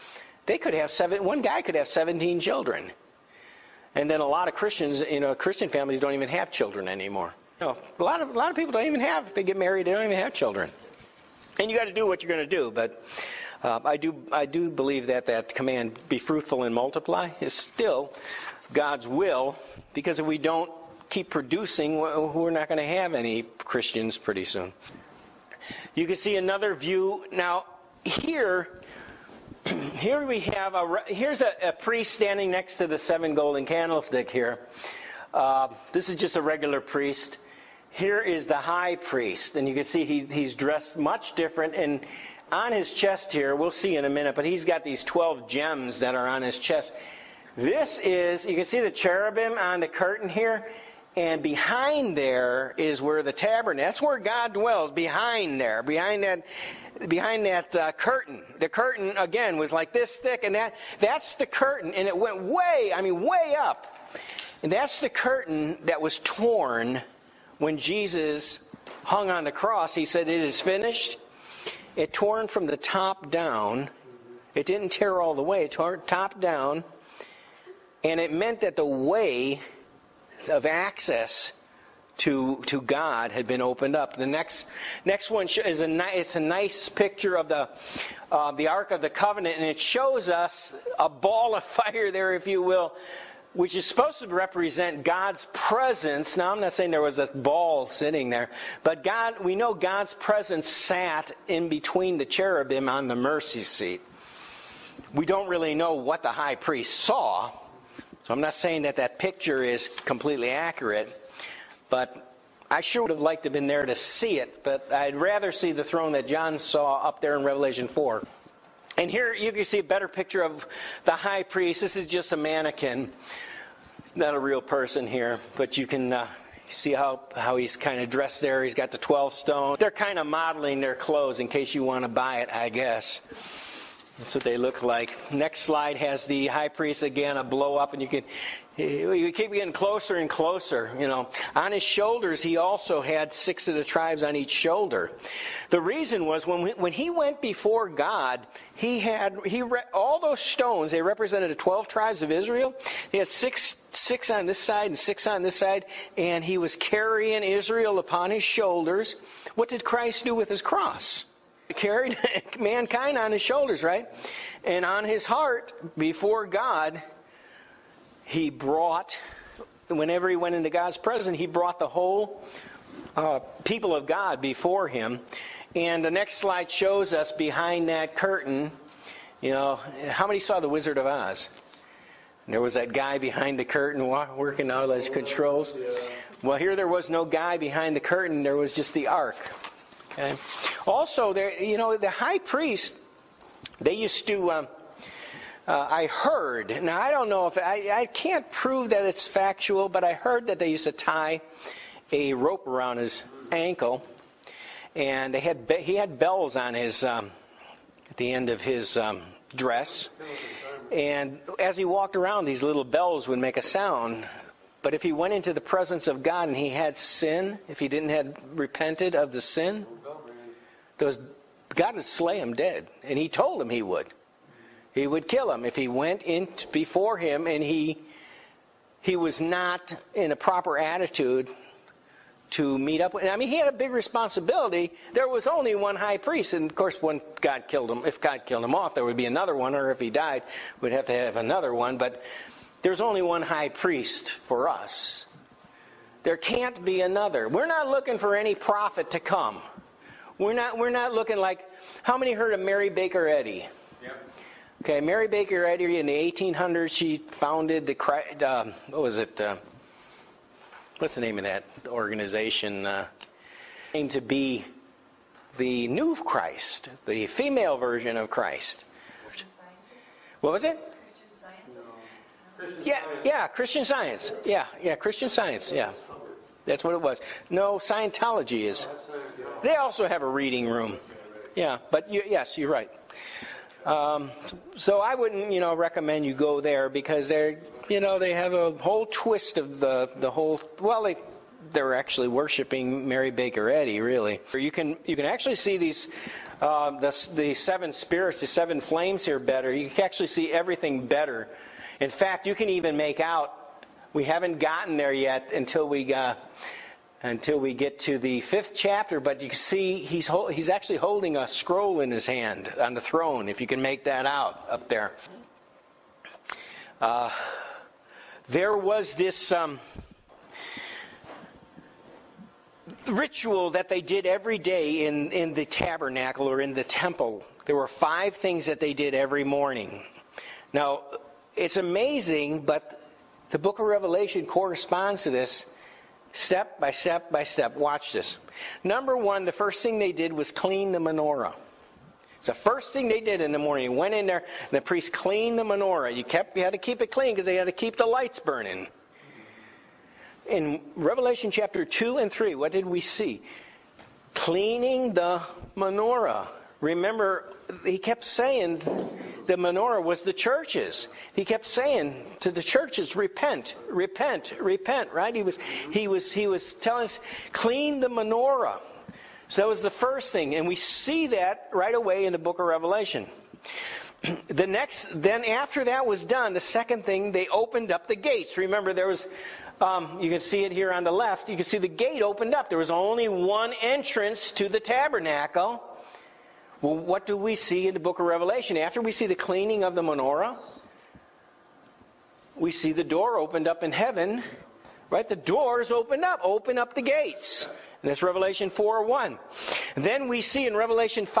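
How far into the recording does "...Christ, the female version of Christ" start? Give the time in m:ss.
4:26.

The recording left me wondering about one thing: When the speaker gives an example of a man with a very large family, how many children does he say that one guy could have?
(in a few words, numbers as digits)
17.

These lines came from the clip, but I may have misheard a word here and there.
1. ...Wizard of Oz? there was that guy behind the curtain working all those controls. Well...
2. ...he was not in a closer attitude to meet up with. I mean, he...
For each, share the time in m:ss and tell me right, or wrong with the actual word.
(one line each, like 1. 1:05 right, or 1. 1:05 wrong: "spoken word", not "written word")
1. 3:00 right
2. 3:48 wrong: "proper", not "closer".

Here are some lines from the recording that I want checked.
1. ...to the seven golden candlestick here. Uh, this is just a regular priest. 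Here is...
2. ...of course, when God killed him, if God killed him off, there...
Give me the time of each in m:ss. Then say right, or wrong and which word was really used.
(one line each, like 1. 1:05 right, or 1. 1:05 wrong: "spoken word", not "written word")
1. 0:32 right
2. 3:56 right.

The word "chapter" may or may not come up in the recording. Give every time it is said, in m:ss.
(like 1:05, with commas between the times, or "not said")
5:08, 5:51.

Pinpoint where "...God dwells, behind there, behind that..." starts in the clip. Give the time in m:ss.
0:54.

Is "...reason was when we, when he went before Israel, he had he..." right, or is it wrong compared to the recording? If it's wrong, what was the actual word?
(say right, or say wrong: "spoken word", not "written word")
wrong: "God", not "Israel".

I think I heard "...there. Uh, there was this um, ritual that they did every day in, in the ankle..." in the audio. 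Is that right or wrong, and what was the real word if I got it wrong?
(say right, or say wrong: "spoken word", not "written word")
wrong: "tabernacle", not "ankle".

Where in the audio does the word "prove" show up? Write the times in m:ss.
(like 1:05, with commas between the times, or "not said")
3:18.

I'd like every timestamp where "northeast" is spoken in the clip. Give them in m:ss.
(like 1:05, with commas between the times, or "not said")
not said.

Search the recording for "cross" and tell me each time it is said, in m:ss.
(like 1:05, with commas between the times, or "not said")
1:09, 2:40.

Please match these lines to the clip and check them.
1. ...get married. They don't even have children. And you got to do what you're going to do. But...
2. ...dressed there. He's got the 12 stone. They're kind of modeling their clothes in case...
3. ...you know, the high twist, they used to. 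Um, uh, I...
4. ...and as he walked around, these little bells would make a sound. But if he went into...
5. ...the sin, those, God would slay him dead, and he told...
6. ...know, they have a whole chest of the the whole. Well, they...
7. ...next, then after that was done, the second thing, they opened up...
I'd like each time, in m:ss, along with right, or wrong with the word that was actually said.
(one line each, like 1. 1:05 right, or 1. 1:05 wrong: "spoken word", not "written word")
1. 0:09 right
2. 2:08 right
3. 3:11 wrong: "priest", not "twist"
4. 3:30 right
5. 3:39 right
6. 4:47 wrong: "twist", not "chest"
7. 6:14 right.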